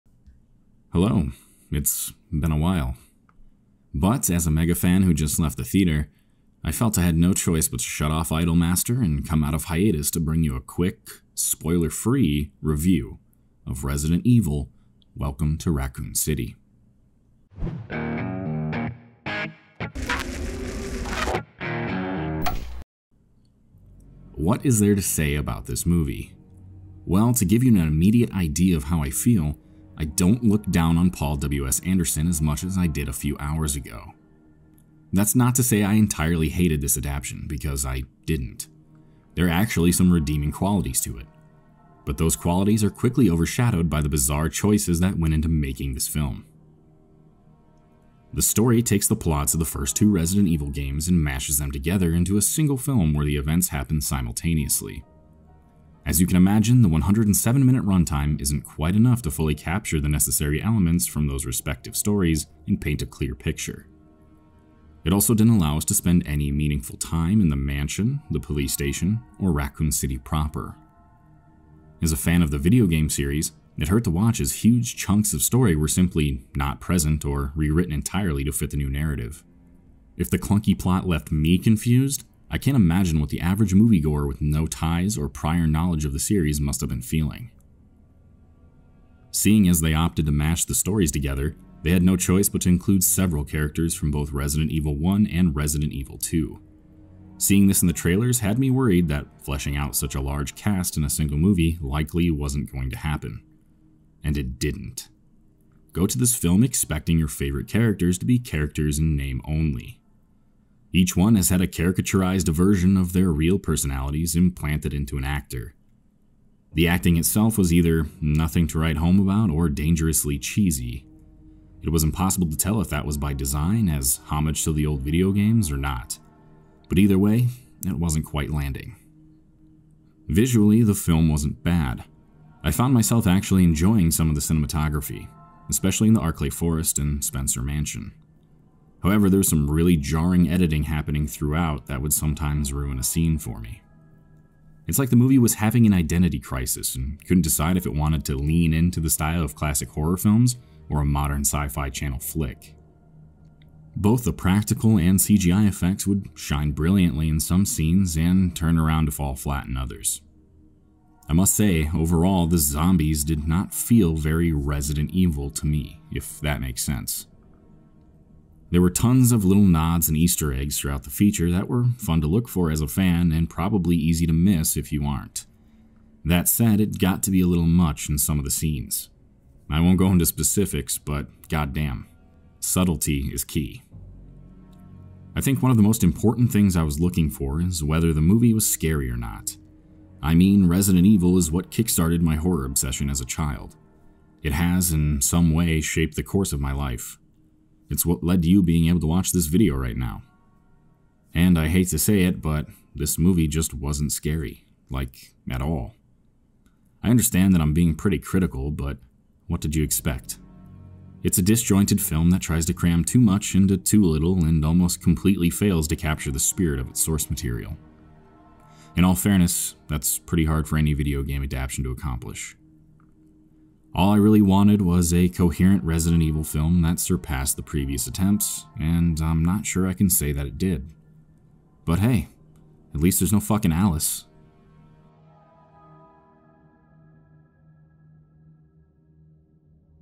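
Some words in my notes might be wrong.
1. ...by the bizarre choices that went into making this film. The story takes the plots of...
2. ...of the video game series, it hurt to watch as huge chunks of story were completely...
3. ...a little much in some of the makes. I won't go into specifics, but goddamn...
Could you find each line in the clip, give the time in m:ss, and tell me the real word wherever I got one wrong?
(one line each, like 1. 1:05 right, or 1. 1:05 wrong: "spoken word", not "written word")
1. 0:43 right
2. 1:12 wrong: "simply", not "completely"
3. 2:57 wrong: "scenes", not "makes".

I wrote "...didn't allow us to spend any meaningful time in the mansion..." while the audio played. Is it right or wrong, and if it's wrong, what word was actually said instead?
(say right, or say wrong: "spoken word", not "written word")
right.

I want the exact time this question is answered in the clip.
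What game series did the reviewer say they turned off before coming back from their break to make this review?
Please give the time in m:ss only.
0:08.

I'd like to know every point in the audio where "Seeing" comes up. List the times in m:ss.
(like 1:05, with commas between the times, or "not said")
1:29, 1:37.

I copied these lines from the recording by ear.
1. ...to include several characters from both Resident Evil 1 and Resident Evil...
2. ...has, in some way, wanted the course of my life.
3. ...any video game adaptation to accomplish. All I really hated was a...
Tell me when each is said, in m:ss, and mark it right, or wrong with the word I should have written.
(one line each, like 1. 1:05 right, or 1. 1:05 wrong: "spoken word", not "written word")
1. 1:32 right
2. 3:14 wrong: "shaped", not "wanted"
3. 3:40 wrong: "wanted", not "hated".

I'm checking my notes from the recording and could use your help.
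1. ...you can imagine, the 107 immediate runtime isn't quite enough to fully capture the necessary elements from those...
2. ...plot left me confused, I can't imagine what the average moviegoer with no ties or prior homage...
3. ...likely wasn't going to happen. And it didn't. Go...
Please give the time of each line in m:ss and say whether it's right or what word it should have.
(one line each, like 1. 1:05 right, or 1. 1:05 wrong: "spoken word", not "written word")
1. 0:56 wrong: "minute", not "immediate"
2. 1:20 wrong: "knowledge", not "homage"
3. 1:41 right.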